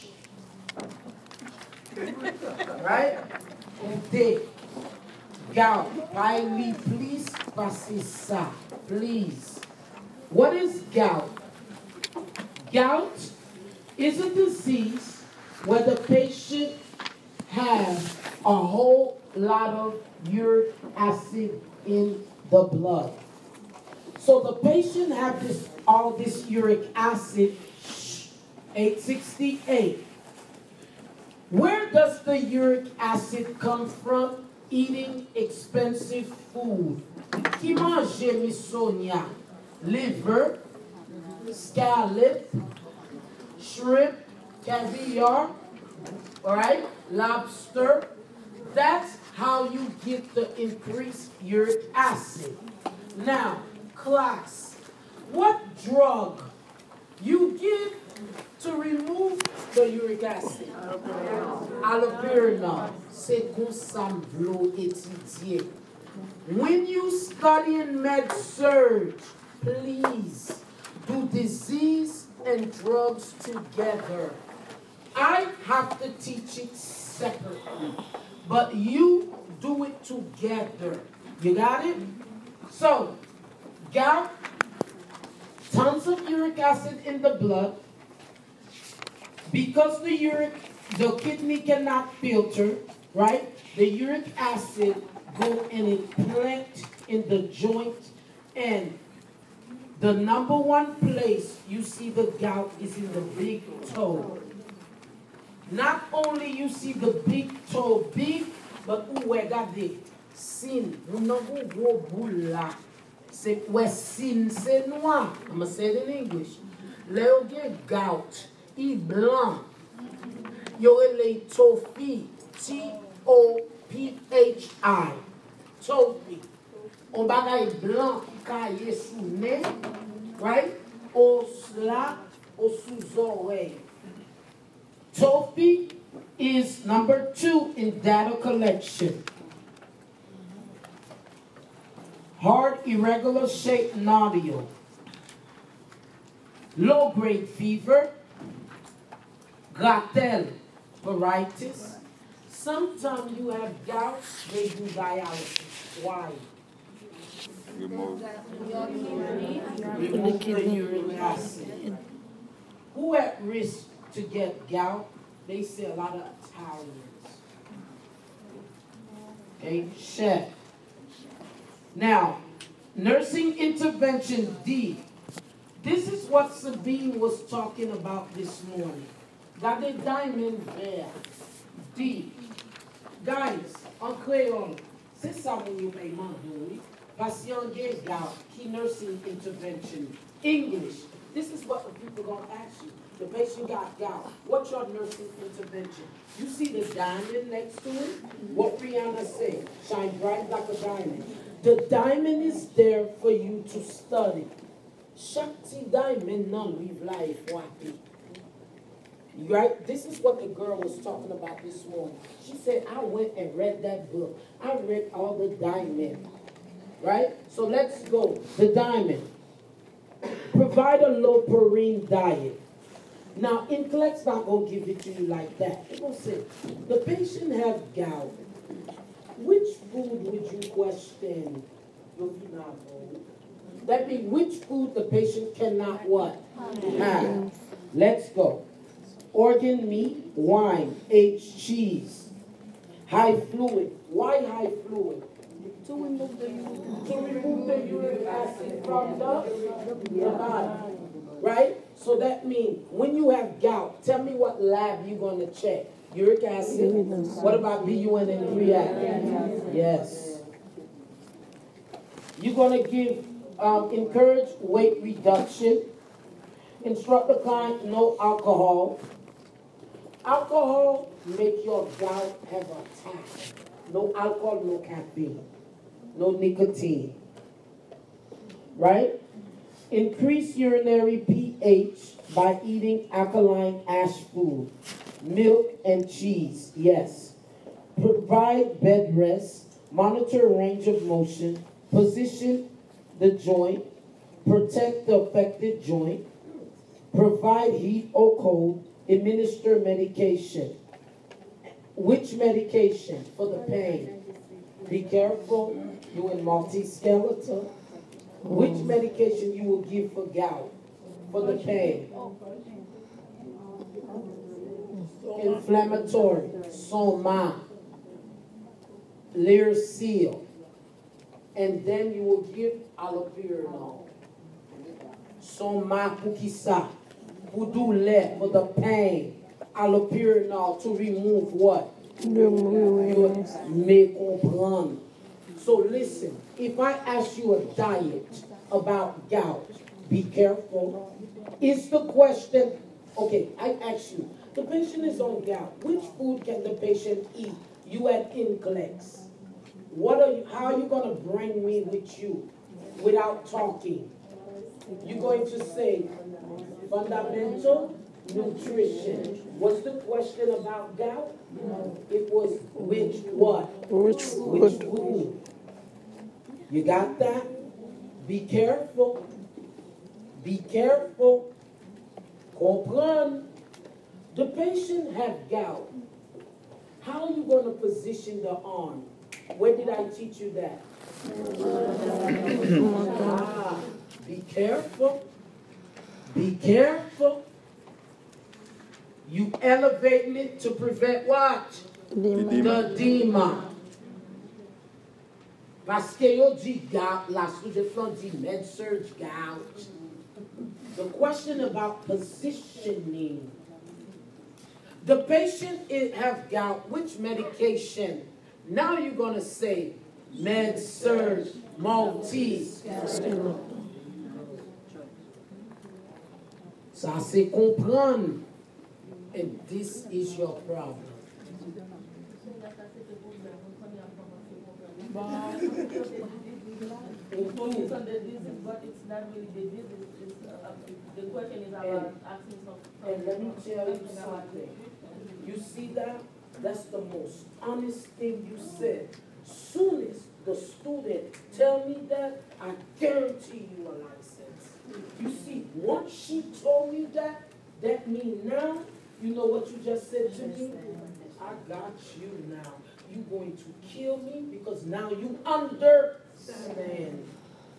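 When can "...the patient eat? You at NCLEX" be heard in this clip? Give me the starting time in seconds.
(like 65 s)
346 s.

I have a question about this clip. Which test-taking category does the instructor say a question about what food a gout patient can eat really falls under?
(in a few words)
fundamental nutrition.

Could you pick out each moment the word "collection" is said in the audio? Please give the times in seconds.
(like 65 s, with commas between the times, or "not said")
138 s.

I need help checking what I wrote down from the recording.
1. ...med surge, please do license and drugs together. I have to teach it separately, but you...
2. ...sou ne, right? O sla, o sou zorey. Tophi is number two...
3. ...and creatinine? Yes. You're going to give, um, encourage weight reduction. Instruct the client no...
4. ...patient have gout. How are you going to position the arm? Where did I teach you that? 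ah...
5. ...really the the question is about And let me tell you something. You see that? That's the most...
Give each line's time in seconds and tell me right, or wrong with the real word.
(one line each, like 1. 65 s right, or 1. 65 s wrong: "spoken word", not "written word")
1. 68 s wrong: "disease", not "license"
2. 129 s right
3. 258 s right
4. 374 s right
5. 429 s right.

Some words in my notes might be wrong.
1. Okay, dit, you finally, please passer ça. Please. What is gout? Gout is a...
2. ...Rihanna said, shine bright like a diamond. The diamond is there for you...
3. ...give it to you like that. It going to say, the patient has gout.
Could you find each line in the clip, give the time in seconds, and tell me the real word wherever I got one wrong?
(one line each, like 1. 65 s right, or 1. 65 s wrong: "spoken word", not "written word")
1. 3 s right
2. 198 s right
3. 224 s right.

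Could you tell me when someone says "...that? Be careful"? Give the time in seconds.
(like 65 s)
367 s.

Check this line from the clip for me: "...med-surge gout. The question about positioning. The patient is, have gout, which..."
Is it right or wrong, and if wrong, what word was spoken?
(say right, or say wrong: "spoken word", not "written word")
right.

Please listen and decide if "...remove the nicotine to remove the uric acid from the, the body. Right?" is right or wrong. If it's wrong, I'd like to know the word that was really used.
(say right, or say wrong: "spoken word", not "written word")
wrong: "urine", not "nicotine".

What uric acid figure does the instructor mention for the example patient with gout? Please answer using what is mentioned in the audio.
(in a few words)
868.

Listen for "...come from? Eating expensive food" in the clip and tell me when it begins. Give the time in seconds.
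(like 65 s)
33 s.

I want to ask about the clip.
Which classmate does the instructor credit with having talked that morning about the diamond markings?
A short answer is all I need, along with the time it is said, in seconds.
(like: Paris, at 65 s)
Sabine, at 176 s.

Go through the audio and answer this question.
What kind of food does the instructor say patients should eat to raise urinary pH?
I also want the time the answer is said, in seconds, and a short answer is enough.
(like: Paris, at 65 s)
alkaline ash food, at 283 s.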